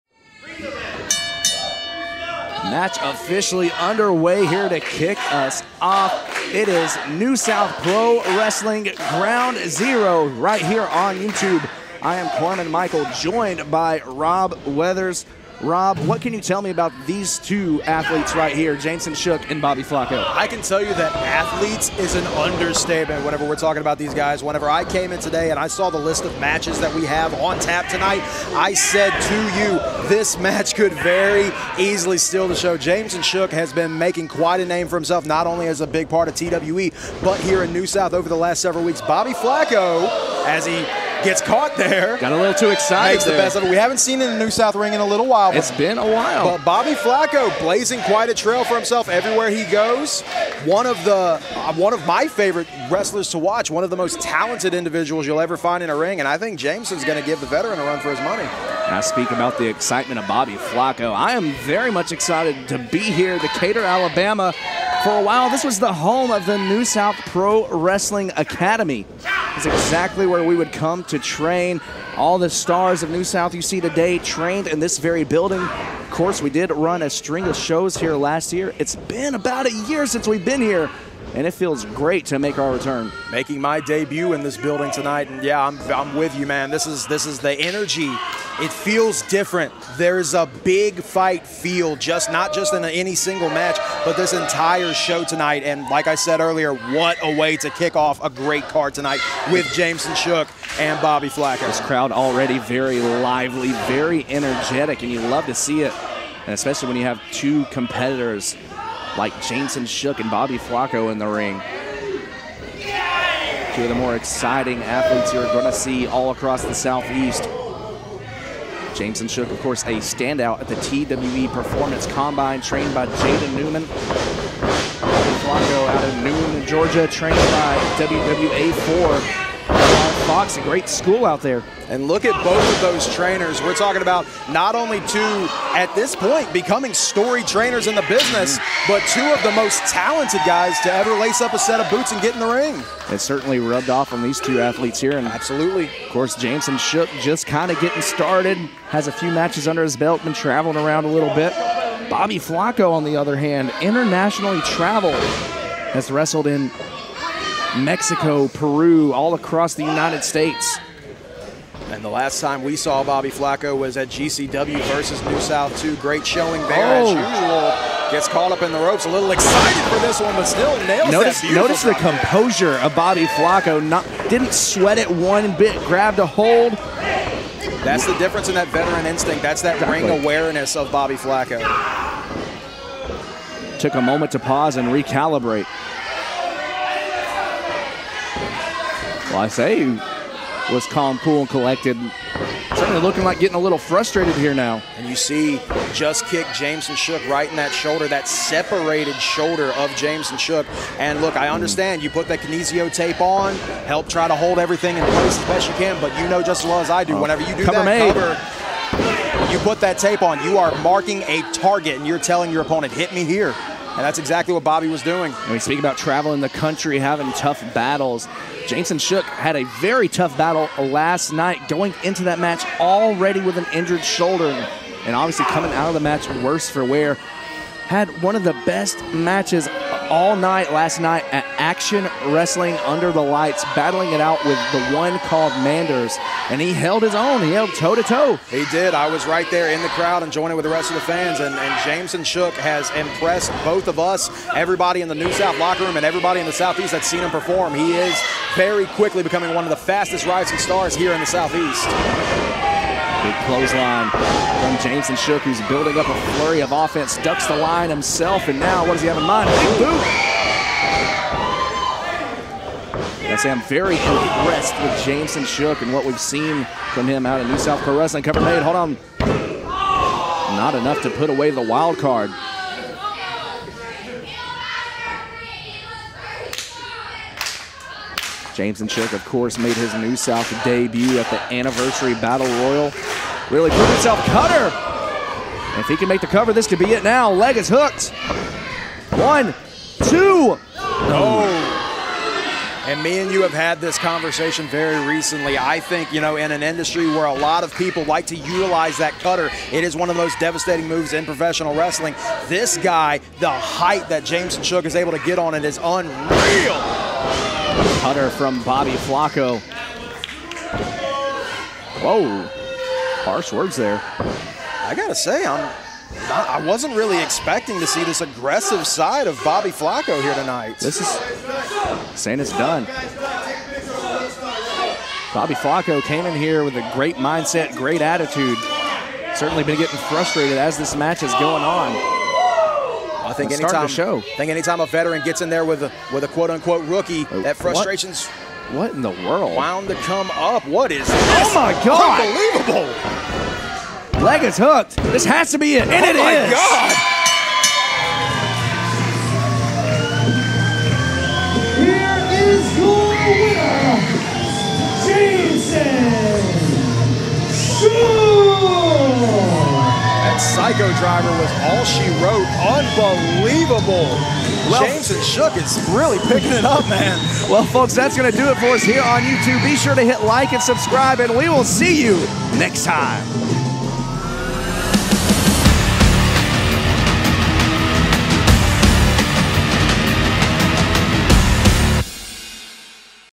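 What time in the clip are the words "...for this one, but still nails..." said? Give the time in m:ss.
2:49.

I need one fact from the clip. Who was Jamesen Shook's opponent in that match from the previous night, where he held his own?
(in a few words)
Manders.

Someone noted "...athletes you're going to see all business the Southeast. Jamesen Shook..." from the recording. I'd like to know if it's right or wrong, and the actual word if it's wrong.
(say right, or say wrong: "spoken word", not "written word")
wrong: "across", not "business".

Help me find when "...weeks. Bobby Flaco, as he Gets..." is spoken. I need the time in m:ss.
0:38.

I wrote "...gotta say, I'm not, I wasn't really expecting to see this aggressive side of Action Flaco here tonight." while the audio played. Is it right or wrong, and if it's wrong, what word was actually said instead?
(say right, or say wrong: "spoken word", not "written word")
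wrong: "Bobby", not "Action".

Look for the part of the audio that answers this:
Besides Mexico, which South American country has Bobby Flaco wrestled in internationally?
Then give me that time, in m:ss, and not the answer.
2:38.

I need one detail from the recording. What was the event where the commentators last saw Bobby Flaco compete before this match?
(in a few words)
GCW versus New South 2.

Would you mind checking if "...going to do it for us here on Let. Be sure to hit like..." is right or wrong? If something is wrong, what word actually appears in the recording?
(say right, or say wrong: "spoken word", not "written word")
wrong: "YouTube", not "Let".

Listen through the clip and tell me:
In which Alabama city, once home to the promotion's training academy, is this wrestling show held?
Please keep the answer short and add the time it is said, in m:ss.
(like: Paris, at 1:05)
Decatur, at 1:03.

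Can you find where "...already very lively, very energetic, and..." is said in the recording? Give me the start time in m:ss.
1:42.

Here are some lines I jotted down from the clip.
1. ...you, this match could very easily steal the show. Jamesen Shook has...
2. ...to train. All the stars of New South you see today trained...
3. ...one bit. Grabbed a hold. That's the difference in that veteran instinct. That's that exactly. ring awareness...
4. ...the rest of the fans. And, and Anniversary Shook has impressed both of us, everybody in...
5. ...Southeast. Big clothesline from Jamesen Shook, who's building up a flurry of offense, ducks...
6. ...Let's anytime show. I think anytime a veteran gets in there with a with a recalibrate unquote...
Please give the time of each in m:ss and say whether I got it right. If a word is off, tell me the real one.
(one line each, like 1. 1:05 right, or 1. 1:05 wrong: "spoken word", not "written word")
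1. 0:29 right
2. 1:11 right
3. 2:55 right
4. 4:00 wrong: "Jamesen", not "Anniversary"
5. 4:11 right
6. 5:33 wrong: "quote", not "recalibrate".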